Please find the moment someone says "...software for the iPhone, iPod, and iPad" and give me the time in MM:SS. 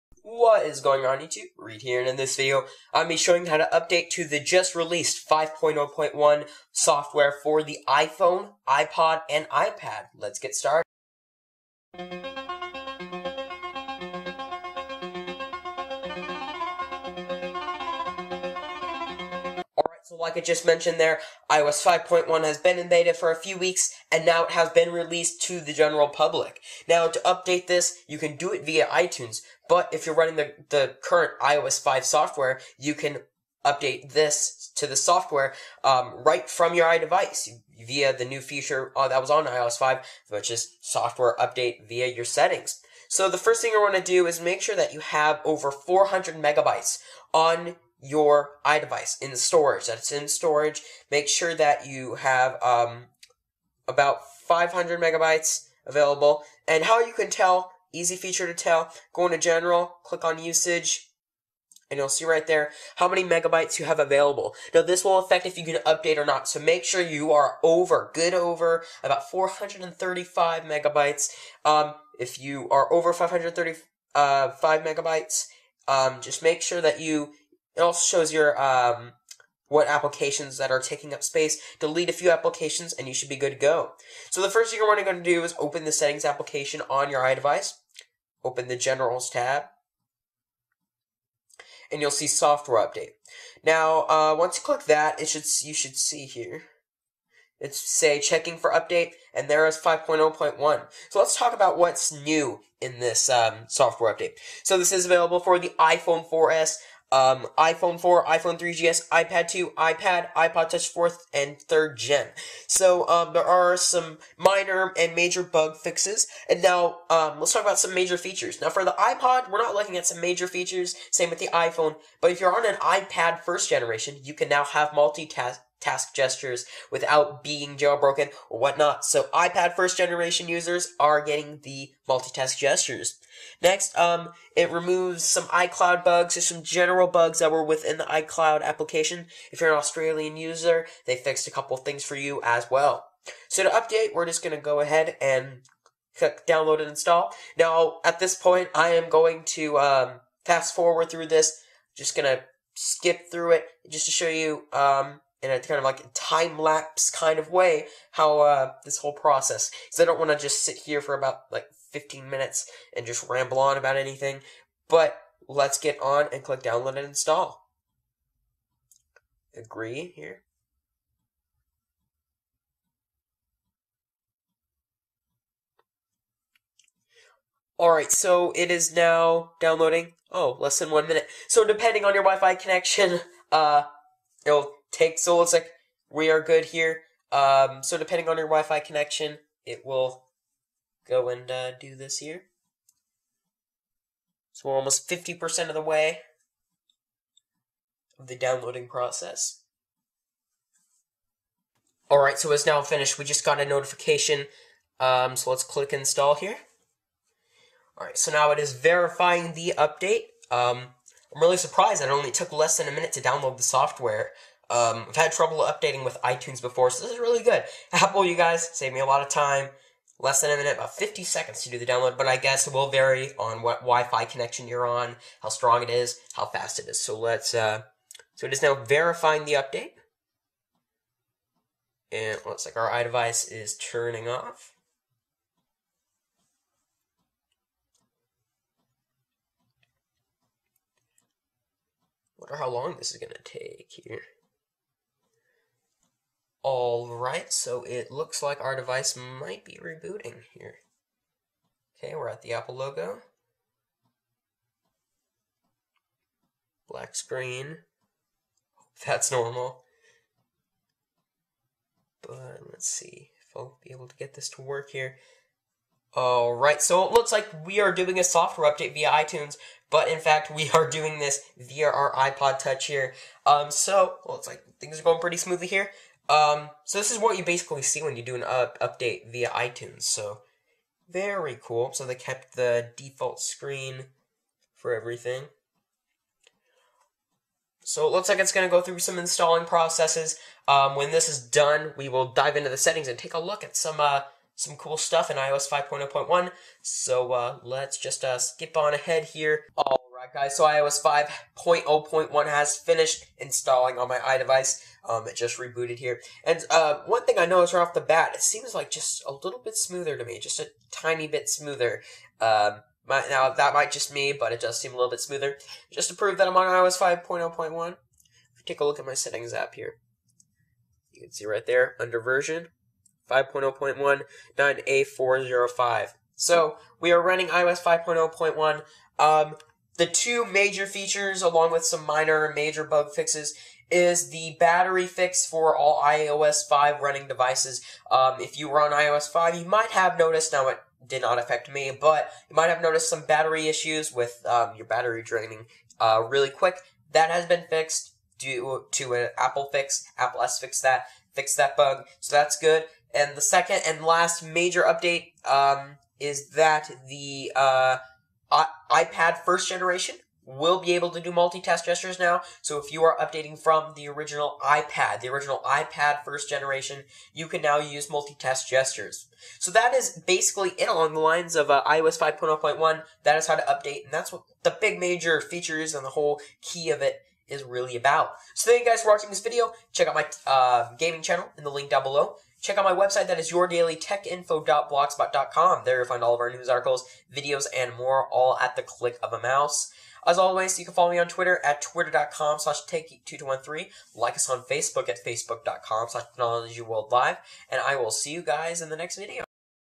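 00:06.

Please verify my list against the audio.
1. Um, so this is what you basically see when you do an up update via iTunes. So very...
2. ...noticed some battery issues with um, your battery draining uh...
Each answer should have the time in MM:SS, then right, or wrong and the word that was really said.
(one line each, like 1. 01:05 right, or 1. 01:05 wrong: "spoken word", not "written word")
1. 04:36 right
2. 05:42 right.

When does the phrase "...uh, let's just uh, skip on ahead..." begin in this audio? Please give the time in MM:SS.
04:57.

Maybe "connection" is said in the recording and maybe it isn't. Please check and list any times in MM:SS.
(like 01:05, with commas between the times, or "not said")
03:02, 03:08, 03:44.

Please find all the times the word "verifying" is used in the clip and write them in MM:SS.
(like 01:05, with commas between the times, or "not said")
03:28, 03:48.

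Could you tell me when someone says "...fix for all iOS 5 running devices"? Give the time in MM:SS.
05:35.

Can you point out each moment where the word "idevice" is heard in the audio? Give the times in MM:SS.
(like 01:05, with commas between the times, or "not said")
00:36, 00:48, 01:27, 03:52, 05:04.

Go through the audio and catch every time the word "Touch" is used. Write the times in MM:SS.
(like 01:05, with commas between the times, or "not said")
01:50, 04:32.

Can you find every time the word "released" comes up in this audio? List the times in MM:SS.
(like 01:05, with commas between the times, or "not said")
00:04, 00:24.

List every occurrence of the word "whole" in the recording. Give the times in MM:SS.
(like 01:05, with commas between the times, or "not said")
02:38, 06:16.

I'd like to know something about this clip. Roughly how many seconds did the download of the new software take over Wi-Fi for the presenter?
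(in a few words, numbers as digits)
50 seconds.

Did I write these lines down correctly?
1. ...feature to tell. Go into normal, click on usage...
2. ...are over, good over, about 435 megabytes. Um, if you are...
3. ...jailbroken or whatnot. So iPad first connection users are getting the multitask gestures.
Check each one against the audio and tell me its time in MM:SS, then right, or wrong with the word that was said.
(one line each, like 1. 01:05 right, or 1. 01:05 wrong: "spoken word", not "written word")
1. 00:58 wrong: "general", not "normal"
2. 01:07 right
3. 02:07 wrong: "generation", not "connection".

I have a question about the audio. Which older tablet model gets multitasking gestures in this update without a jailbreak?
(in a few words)
iPad 1st generation.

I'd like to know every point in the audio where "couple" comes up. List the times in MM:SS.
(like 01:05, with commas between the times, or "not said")
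02:21.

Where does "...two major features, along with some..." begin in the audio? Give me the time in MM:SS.
05:30.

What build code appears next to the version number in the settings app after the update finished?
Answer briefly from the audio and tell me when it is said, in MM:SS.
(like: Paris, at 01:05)
9A405, at 05:24.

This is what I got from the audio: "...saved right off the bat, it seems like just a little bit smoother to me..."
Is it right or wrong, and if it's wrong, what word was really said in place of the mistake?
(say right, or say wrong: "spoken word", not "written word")
wrong: "noticed", not "saved".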